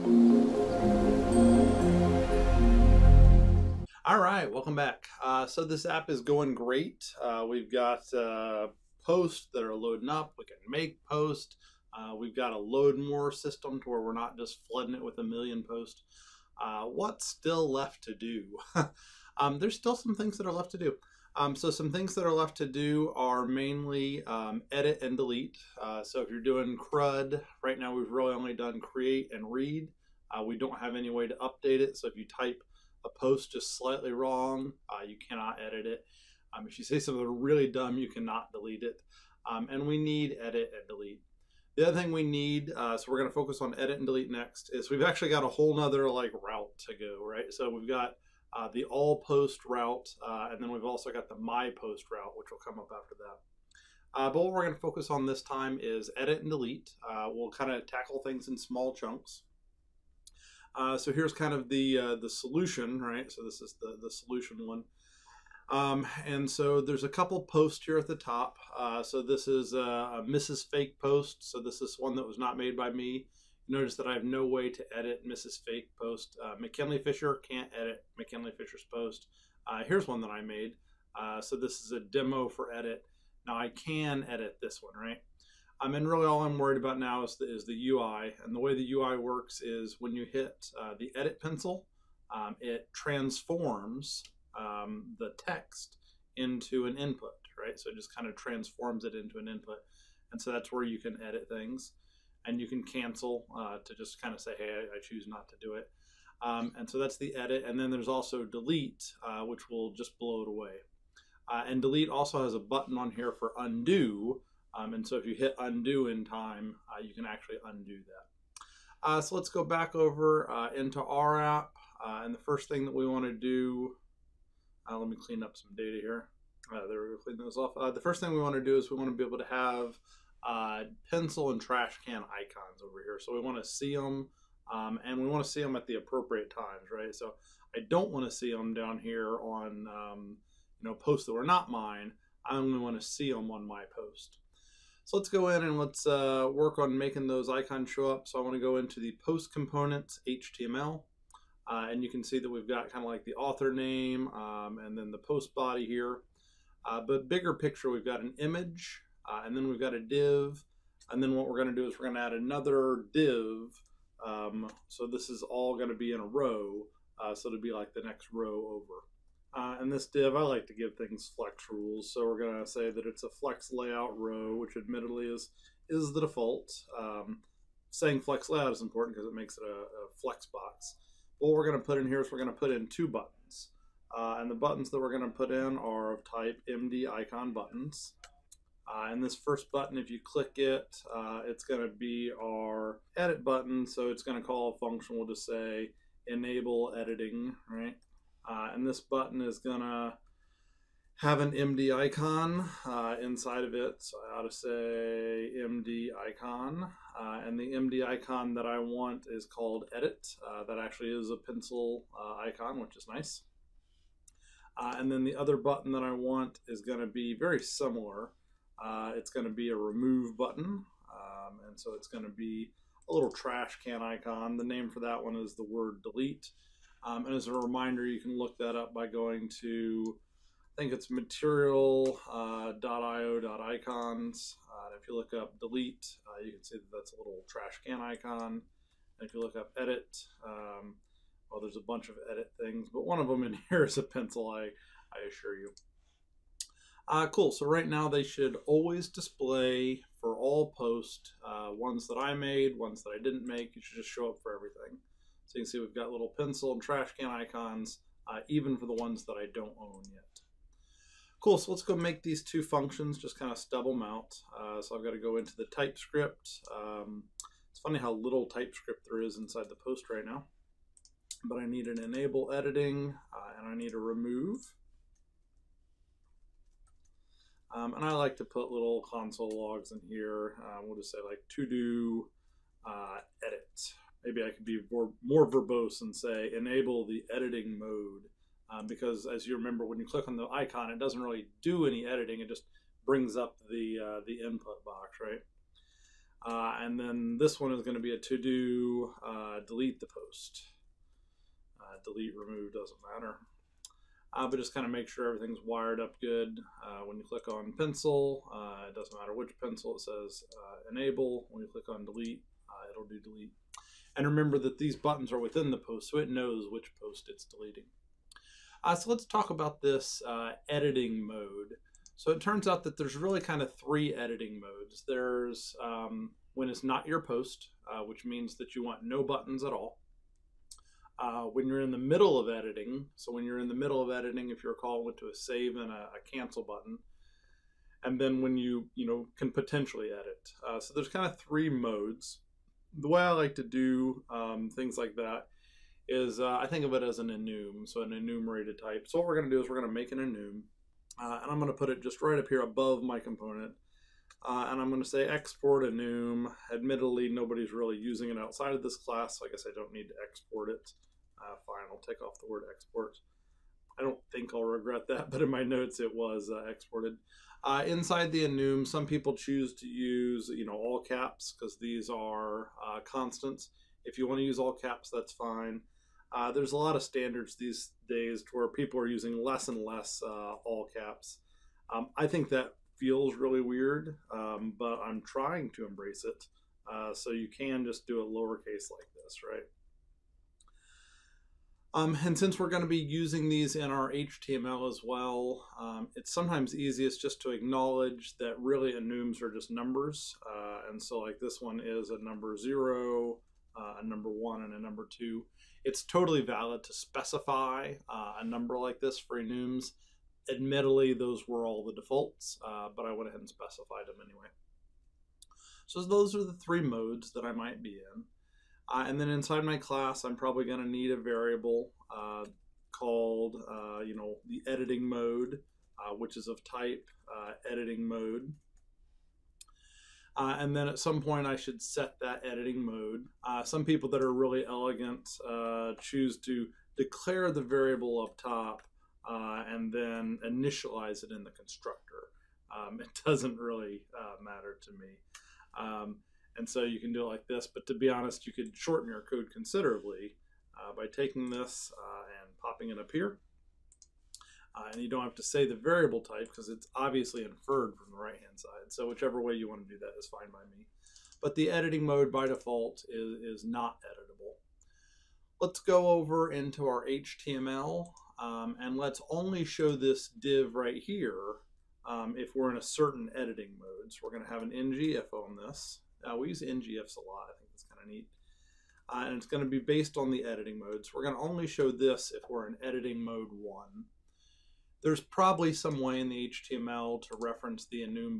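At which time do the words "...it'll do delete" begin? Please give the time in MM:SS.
05:12.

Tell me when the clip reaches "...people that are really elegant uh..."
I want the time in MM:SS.
07:13.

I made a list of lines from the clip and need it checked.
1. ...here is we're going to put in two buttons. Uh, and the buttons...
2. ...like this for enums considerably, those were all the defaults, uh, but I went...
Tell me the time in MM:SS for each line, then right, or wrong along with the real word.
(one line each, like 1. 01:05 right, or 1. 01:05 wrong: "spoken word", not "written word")
1. 03:02 right
2. 06:48 wrong: "admittedly", not "considerably".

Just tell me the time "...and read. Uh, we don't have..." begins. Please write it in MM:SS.
00:29.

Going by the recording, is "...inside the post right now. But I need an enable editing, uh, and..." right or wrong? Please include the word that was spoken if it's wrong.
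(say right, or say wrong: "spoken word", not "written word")
right.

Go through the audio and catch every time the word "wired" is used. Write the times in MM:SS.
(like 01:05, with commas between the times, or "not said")
05:05.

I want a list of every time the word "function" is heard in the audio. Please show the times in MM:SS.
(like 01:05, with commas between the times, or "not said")
03:14, 04:22.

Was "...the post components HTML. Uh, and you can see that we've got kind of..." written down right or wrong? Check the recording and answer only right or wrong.
right.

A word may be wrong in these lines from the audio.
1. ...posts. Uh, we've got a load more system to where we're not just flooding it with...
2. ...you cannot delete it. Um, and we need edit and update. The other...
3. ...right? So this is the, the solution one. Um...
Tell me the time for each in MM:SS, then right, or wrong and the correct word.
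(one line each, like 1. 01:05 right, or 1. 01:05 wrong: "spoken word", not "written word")
1. 00:11 right
2. 00:37 wrong: "delete", not "update"
3. 01:03 right.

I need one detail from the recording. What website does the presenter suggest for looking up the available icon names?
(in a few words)
material.io/icons.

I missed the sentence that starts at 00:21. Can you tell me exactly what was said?
Um, so some things that are left to do are mainly um, edit and delete.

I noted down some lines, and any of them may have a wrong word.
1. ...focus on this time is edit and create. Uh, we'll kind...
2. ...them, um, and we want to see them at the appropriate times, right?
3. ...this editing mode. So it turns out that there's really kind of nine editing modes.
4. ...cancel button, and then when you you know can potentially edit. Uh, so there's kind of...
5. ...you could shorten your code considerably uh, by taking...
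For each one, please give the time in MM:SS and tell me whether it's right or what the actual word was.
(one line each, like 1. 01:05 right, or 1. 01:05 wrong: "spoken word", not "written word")
1. 00:54 wrong: "delete", not "create"
2. 02:13 right
3. 05:19 wrong: "three", not "nine"
4. 05:36 right
5. 07:28 right.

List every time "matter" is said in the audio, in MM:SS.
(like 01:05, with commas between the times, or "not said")
05:03, 05:09, 07:24.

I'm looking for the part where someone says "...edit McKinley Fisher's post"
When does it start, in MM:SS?
01:17.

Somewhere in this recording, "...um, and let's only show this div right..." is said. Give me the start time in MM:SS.
07:48.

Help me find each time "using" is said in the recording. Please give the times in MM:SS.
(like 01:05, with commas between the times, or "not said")
05:57, 06:19, 06:32.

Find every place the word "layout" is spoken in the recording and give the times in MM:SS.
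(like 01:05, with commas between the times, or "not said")
02:53, 02:58.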